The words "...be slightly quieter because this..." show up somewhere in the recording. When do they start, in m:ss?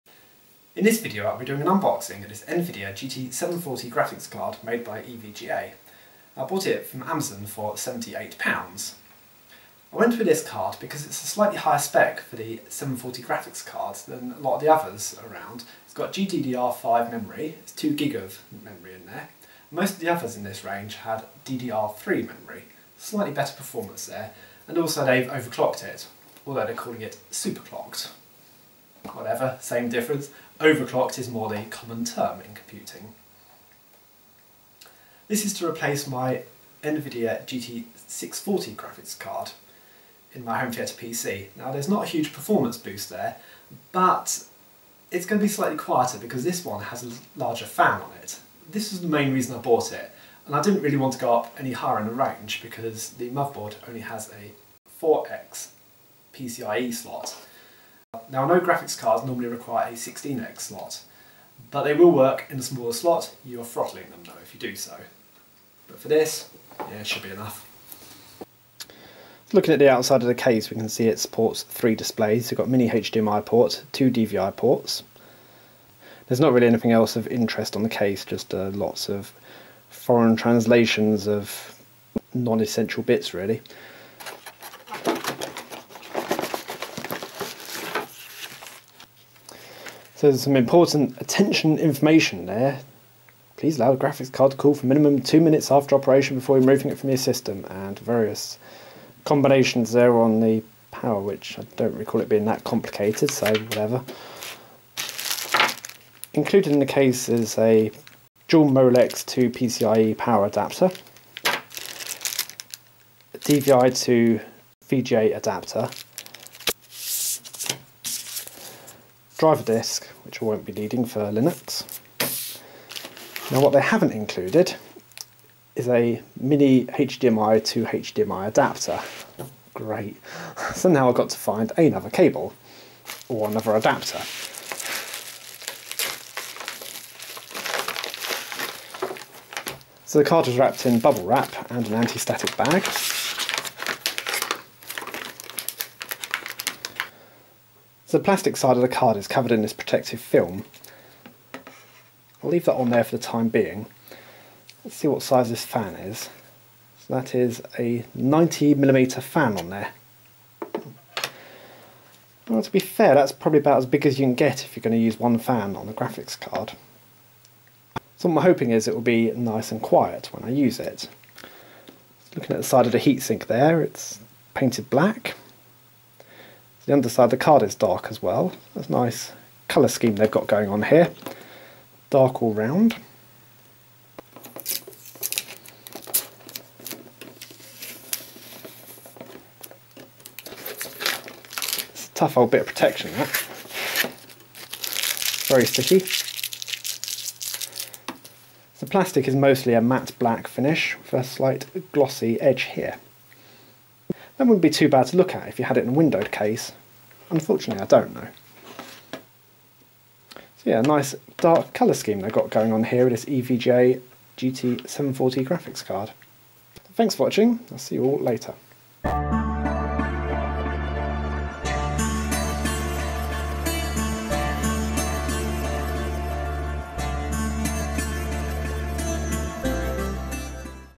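0:45.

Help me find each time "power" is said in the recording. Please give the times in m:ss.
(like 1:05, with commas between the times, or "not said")
1:40, 1:50.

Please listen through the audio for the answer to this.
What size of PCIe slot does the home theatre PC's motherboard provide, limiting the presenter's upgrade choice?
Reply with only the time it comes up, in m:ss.
0:55.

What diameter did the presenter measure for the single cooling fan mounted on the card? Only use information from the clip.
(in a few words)
90mm.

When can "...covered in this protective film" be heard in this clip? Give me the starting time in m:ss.
2:29.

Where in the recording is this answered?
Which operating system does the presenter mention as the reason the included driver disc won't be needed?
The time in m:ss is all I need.
2:01.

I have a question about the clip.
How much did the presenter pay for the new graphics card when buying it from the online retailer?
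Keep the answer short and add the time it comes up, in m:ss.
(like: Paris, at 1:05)
£78, at 0:07.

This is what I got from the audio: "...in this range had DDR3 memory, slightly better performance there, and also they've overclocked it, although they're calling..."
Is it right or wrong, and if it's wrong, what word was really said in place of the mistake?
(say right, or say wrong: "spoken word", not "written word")
right.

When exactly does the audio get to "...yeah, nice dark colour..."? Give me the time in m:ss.
3:30.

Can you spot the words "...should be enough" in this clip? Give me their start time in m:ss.
1:07.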